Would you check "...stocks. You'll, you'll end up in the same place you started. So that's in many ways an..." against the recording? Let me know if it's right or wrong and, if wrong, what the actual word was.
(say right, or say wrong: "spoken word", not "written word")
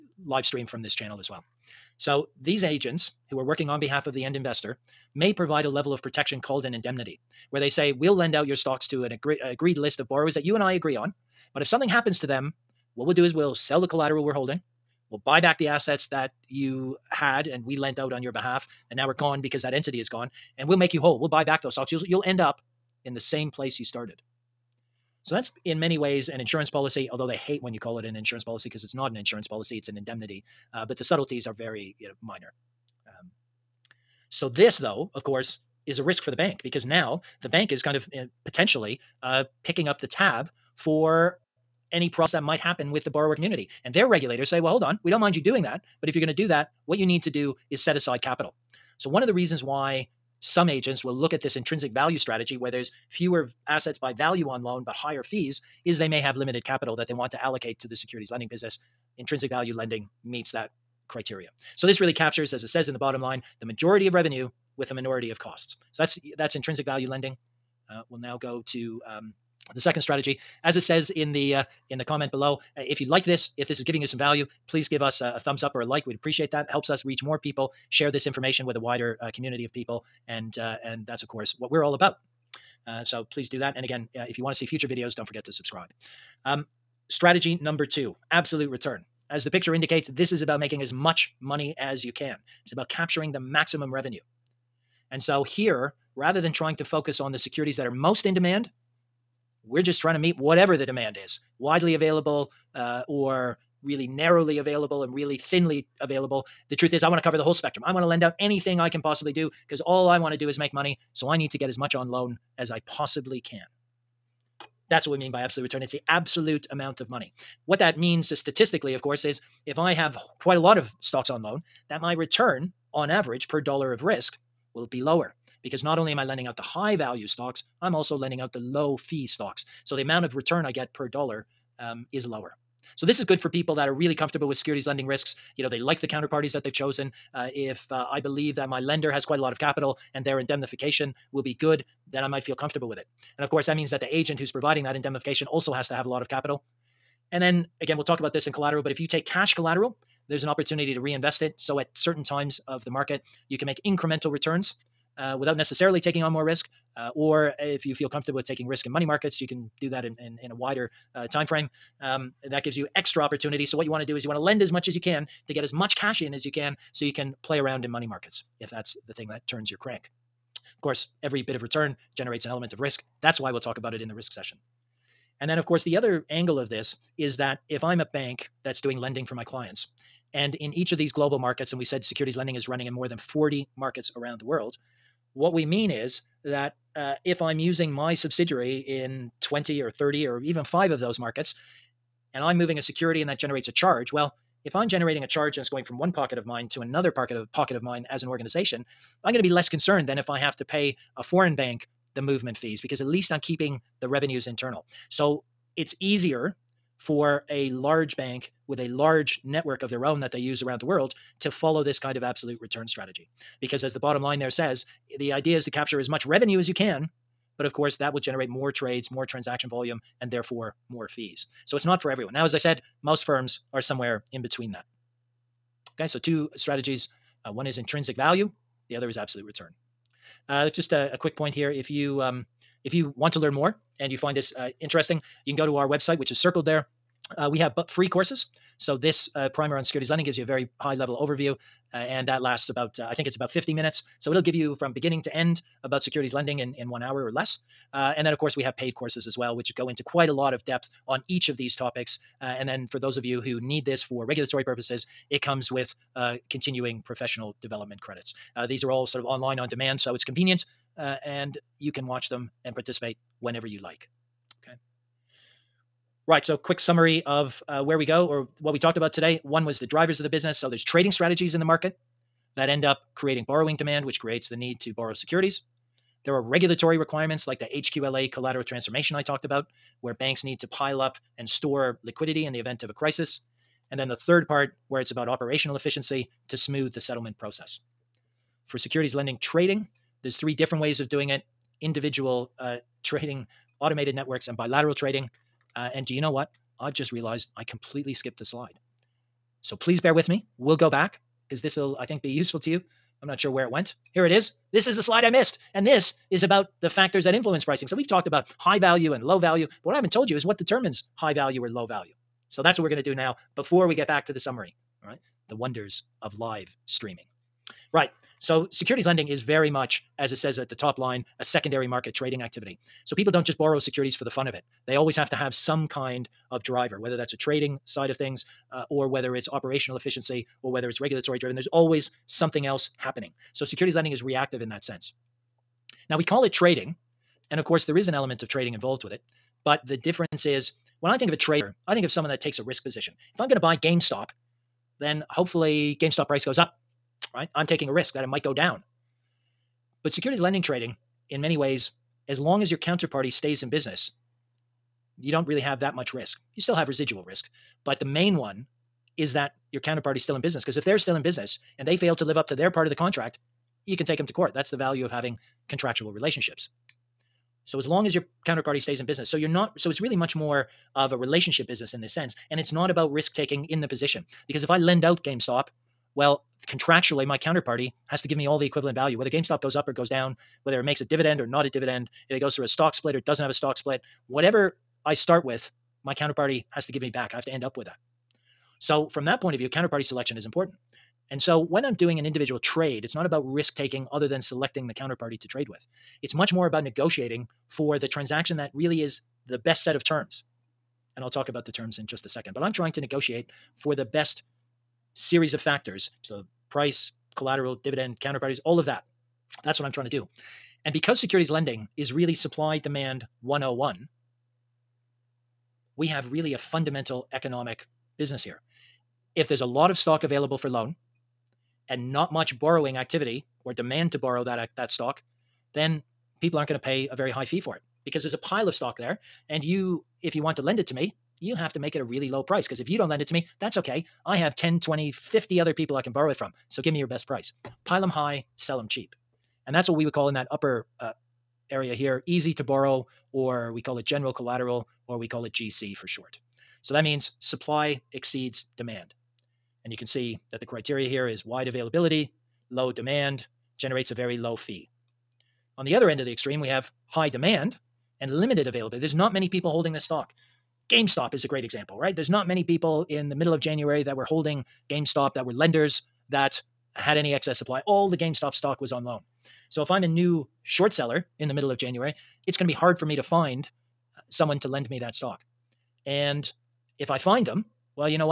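right.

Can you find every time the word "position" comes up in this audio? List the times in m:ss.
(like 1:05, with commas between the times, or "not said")
5:42, 6:13.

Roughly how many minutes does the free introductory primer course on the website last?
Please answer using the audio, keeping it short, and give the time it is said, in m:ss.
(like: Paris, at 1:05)
About 50 minutes, at 4:03.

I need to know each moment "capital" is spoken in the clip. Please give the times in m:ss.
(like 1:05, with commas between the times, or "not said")
0:48, 0:56, 2:19, 2:26.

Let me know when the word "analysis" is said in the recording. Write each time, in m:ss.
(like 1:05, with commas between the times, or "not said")
not said.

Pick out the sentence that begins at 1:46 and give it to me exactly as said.
The truth is, I want to cover the whole spectrum.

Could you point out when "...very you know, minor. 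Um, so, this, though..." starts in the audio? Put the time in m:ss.
0:31.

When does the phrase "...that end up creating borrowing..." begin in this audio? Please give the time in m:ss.
4:32.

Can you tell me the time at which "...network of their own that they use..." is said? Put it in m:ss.
3:29.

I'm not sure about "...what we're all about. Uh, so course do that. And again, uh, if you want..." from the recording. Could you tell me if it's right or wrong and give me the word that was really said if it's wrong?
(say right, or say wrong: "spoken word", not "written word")
wrong: "please", not "course".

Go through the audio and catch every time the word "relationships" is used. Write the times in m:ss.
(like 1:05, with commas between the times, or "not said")
6:06, 6:11.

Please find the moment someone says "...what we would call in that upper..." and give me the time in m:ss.
7:19.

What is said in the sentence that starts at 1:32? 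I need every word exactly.
It's about capturing the maximum revenue.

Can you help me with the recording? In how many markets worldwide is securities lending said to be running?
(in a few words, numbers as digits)
More than 40.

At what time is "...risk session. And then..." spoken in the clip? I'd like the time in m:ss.
2:54.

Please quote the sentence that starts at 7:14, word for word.
I have 10, 20, 50 other people I can borrow it from.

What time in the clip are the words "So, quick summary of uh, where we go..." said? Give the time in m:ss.
4:26.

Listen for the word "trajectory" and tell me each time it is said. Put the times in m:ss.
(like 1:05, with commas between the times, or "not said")
not said.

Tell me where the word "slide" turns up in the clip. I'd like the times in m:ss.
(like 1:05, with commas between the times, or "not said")
4:58, 5:05.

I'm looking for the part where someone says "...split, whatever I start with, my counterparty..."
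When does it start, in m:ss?
6:23.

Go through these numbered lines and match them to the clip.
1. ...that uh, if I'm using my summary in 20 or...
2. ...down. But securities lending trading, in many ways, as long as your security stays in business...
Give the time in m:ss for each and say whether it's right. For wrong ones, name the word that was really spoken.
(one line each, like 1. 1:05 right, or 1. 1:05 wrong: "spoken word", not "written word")
1. 3:06 wrong: "subsidiary", not "summary"
2. 5:48 wrong: "counterparty", not "security".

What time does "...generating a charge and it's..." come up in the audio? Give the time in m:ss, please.
3:14.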